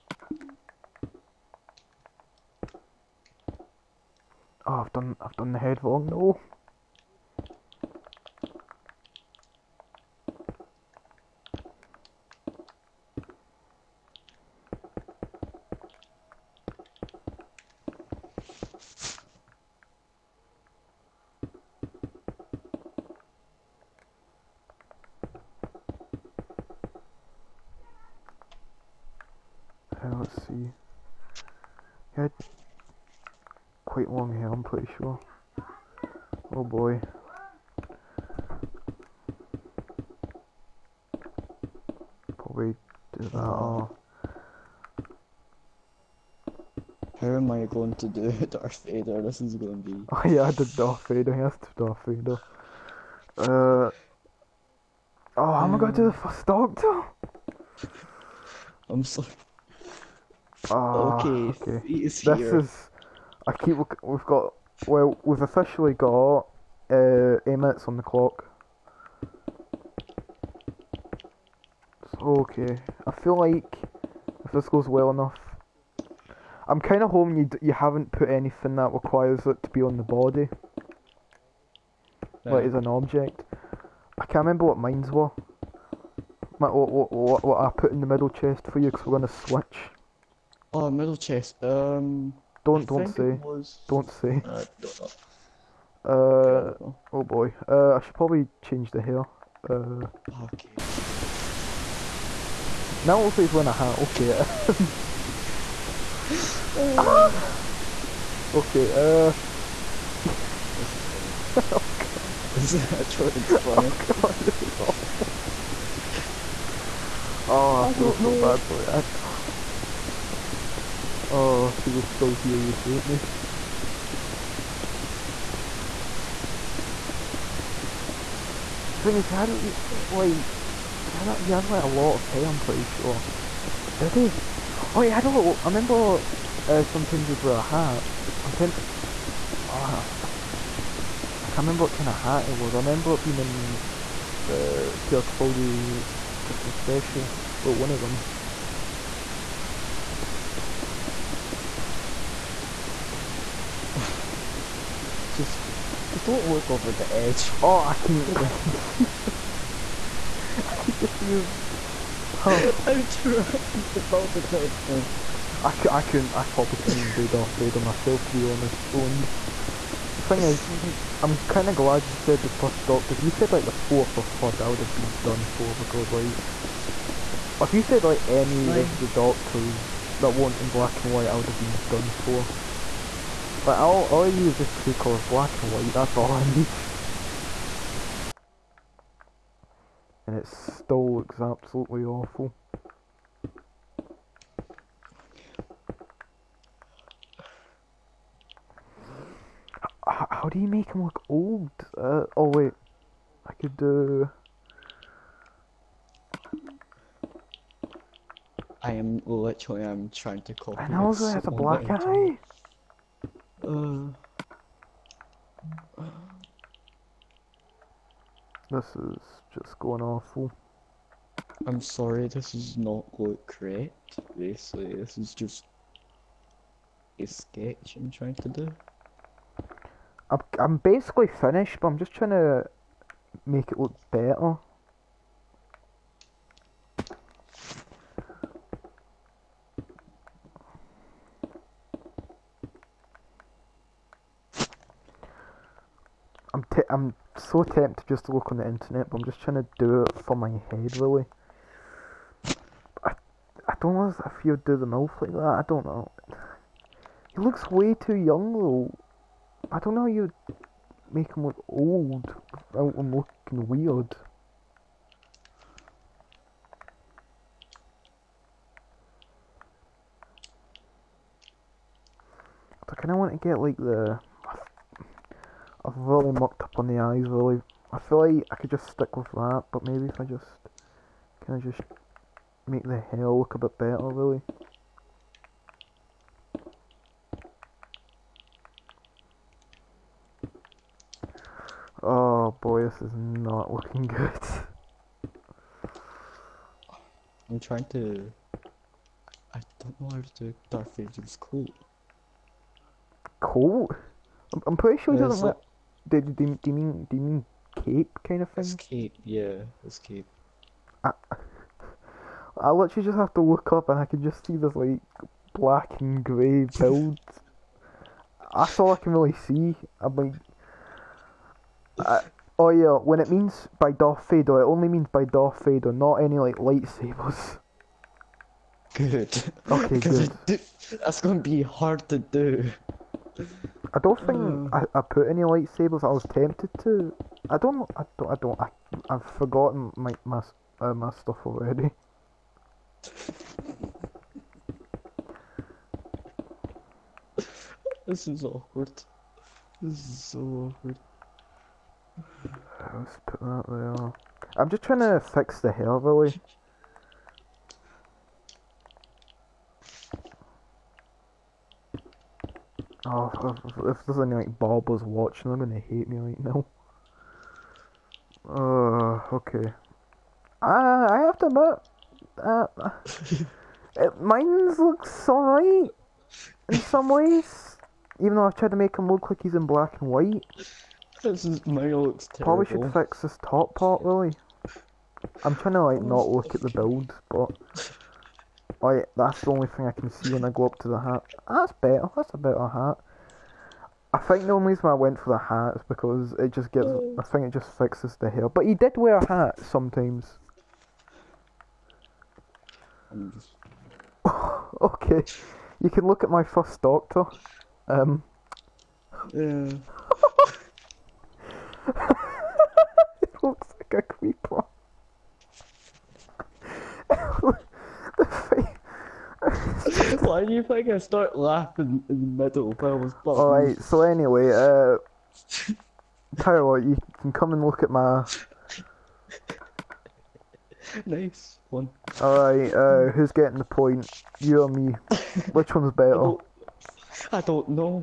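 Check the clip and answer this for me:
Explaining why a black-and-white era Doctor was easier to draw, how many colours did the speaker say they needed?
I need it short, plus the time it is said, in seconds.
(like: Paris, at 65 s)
2, at 184 s.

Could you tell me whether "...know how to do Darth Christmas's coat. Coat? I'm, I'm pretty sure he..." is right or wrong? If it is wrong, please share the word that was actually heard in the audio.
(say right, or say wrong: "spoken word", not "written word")
wrong: "Vader", not "Christmas".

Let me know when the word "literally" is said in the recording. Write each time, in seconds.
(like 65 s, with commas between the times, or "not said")
209 s, 312 s.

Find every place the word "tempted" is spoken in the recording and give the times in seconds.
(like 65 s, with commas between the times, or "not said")
247 s, 336 s.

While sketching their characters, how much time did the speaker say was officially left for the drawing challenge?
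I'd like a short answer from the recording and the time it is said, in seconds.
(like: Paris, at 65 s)
8 minutes, at 67 s.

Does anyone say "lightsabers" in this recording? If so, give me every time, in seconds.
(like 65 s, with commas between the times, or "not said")
326 s, 335 s.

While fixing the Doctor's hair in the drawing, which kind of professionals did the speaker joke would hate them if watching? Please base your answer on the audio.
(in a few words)
barbers.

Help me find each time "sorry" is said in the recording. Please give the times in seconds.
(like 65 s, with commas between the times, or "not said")
59 s, 221 s.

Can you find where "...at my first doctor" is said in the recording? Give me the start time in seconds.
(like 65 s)
406 s.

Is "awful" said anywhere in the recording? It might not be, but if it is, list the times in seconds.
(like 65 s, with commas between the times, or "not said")
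114 s, 192 s, 220 s.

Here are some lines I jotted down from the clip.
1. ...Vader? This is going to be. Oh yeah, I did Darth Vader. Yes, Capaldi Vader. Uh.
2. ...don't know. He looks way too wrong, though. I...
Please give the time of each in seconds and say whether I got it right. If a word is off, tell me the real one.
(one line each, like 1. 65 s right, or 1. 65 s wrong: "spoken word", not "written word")
1. 48 s wrong: "Darth", not "Capaldi"
2. 255 s wrong: "young", not "wrong".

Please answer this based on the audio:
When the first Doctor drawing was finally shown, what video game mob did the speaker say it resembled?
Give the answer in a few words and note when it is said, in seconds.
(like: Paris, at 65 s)
a creeper, at 414 s.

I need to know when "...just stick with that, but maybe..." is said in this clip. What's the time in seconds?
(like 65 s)
278 s.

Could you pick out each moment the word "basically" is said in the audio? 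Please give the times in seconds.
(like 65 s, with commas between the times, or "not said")
224 s, 230 s.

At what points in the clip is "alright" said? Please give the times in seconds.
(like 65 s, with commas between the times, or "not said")
375 s, 423 s, 432 s.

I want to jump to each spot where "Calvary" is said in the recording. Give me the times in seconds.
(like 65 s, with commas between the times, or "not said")
not said.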